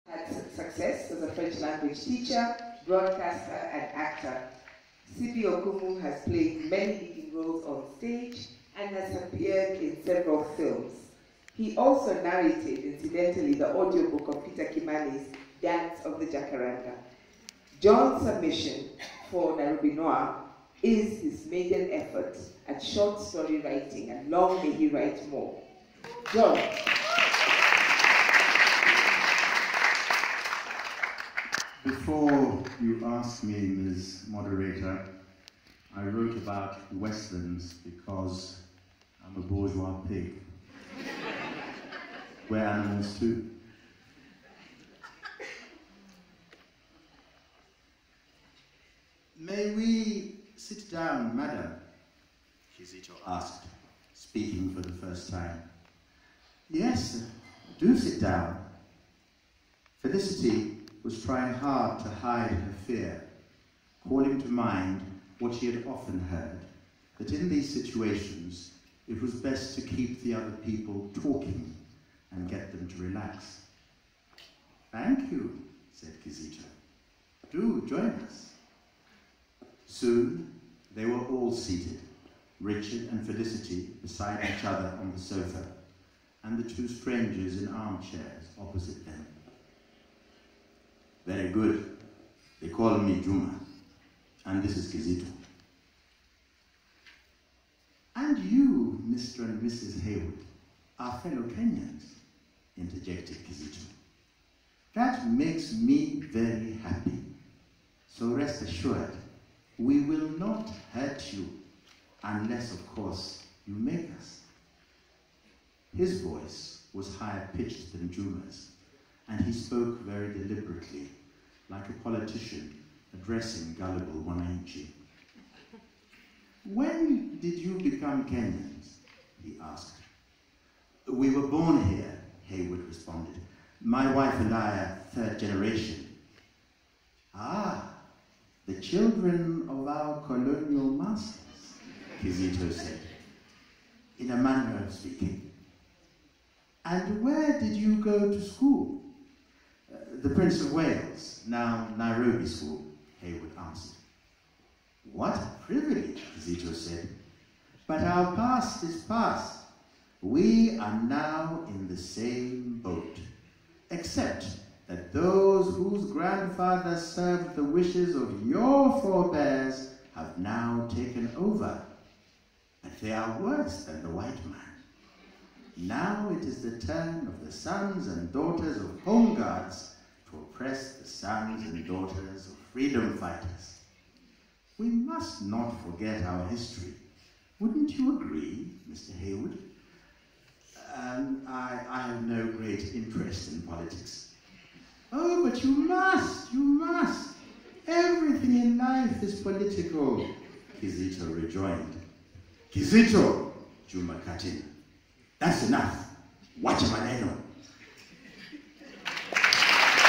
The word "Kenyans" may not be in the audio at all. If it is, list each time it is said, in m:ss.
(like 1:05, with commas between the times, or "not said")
1:41, 2:08.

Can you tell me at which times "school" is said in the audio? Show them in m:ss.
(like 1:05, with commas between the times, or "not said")
2:28, 2:32.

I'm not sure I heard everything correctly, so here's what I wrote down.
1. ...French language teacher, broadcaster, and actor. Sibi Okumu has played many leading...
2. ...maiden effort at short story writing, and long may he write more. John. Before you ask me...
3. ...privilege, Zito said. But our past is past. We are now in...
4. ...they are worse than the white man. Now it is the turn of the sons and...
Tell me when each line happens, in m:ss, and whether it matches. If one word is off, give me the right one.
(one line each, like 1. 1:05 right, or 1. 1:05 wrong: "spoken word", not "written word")
1. 0:01 right
2. 0:21 right
3. 2:35 right
4. 2:53 right.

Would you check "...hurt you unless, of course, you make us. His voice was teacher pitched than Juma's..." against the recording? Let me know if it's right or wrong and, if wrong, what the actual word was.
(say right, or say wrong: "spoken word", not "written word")
wrong: "higher", not "teacher".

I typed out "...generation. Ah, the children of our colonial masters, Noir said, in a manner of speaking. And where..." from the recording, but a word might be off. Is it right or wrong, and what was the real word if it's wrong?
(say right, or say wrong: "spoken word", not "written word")
wrong: "Kizito", not "Noir".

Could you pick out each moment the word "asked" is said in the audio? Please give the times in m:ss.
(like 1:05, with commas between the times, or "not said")
0:53, 2:09.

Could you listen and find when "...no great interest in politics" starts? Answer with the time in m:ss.
3:12.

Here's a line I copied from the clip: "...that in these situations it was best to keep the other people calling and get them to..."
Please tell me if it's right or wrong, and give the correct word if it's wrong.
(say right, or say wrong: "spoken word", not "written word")
wrong: "talking", not "calling".